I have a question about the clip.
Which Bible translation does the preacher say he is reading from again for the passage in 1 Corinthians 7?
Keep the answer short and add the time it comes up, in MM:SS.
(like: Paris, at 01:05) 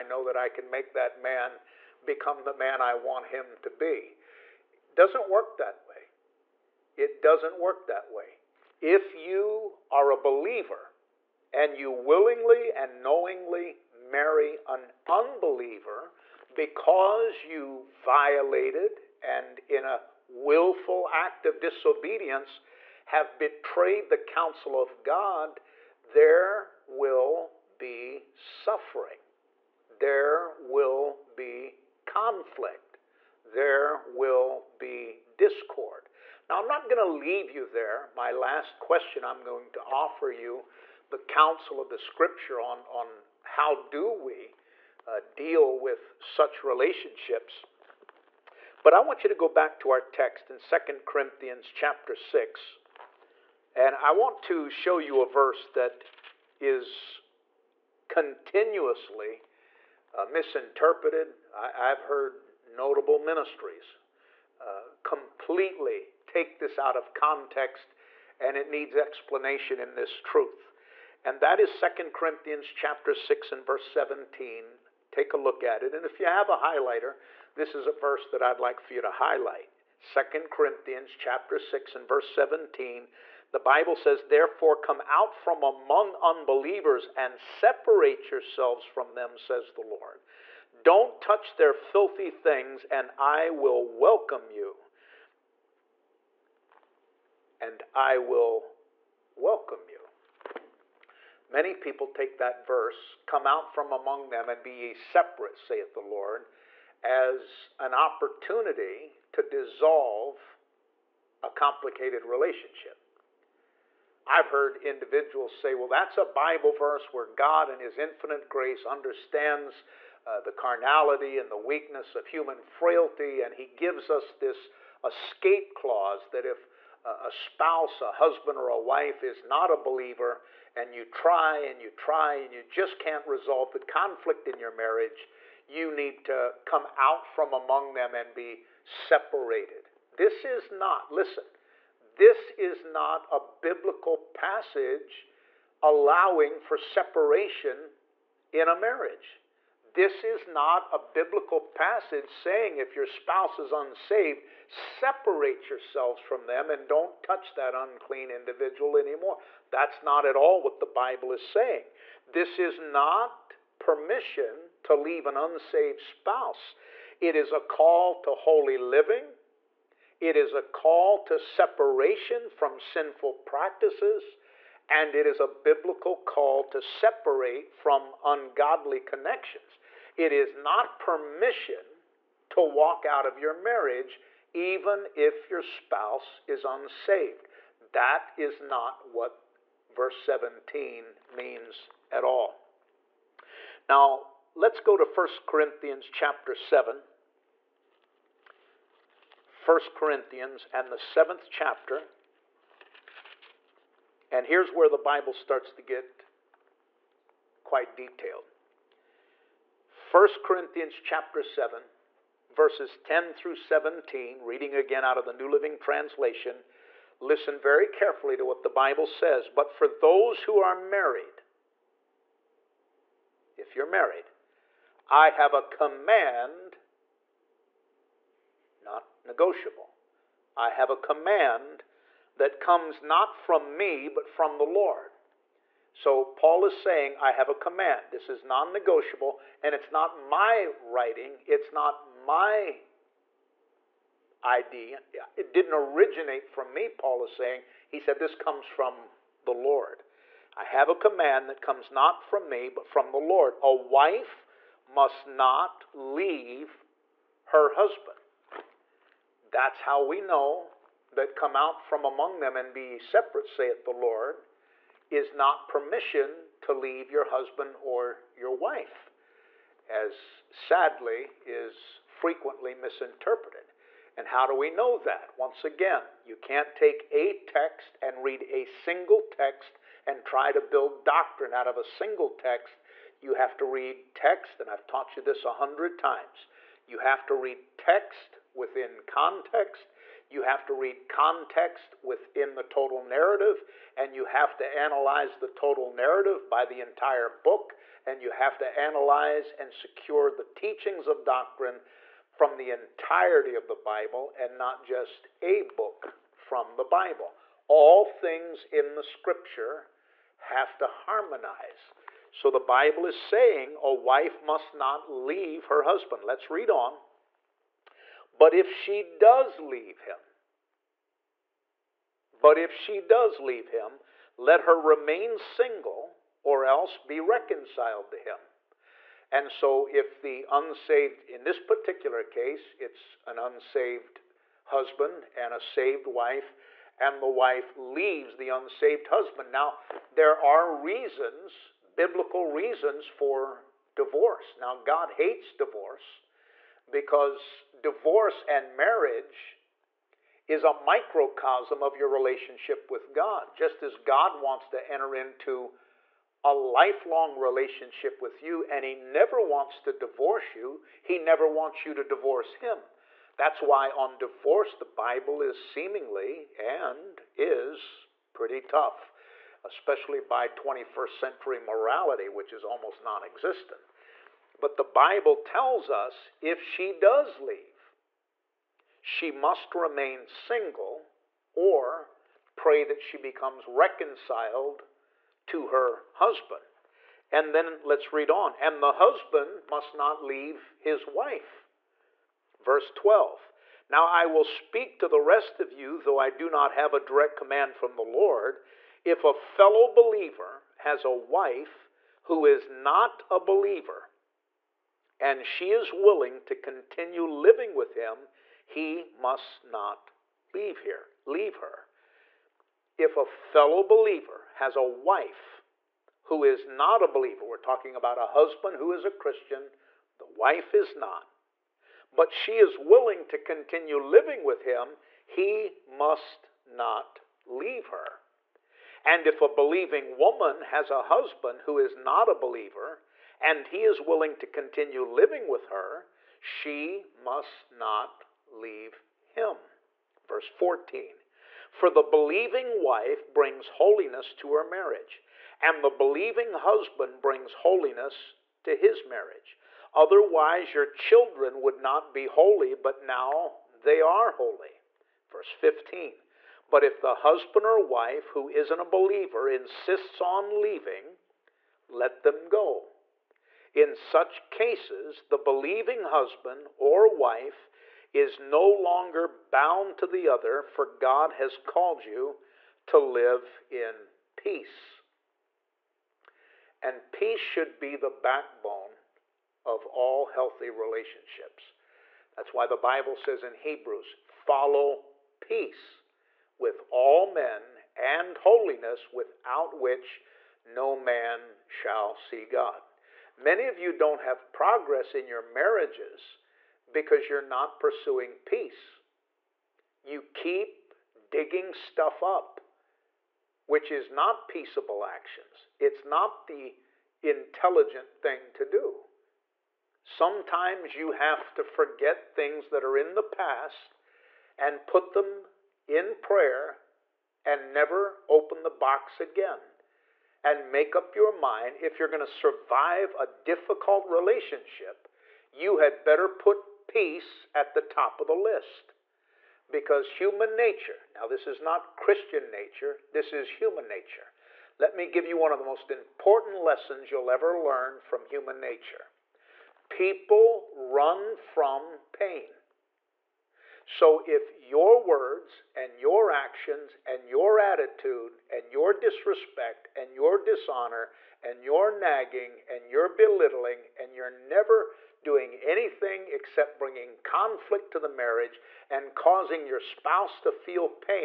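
New Living Translation, at 03:35.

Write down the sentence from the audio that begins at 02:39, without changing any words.
That's not at all what the Bible is saying.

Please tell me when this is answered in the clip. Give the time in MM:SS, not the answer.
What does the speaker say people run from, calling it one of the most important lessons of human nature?
09:02.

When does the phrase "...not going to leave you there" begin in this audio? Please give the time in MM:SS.
00:36.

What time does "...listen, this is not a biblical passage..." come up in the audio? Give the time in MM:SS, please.
02:21.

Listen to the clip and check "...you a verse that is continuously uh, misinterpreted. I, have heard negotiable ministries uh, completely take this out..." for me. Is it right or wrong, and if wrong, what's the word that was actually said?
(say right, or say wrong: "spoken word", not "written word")
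wrong: "notable", not "negotiable".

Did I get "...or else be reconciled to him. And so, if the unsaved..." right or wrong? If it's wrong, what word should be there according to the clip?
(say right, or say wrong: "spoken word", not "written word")
right.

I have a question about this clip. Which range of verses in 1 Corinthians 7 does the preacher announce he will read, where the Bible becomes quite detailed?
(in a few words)
10 through 17.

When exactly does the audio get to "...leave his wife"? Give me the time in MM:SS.
06:30.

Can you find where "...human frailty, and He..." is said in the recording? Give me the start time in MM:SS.
02:02.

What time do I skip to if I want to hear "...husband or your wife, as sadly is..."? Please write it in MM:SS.
04:27.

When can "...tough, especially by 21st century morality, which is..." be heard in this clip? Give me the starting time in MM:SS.
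06:08.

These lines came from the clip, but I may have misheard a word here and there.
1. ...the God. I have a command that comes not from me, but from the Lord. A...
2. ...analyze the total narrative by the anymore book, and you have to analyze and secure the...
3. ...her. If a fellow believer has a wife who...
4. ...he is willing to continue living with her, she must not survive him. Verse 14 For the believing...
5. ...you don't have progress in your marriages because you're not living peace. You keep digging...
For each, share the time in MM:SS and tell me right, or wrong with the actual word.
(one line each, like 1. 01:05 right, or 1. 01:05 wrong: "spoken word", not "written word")
1. 04:09 wrong: "Lord", not "God"
2. 04:54 wrong: "entire", not "anymore"
3. 06:51 right
4. 07:13 wrong: "leave", not "survive"
5. 08:13 wrong: "pursuing", not "living".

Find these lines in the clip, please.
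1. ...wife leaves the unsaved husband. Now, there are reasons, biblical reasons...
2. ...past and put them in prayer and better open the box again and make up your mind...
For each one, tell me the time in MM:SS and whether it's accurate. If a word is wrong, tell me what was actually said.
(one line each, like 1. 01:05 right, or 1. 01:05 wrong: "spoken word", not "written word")
1. 05:37 right
2. 08:33 wrong: "never", not "better".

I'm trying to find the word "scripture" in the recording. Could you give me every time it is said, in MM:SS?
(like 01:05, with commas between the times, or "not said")
00:41, 05:09.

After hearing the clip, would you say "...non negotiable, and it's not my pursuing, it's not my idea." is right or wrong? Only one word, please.
wrong.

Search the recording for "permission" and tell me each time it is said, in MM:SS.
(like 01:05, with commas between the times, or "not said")
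02:43, 03:00, 04:25.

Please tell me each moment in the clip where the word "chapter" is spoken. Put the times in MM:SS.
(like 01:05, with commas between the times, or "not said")
00:51, 01:12, 01:21, 03:16, 03:21, 03:30.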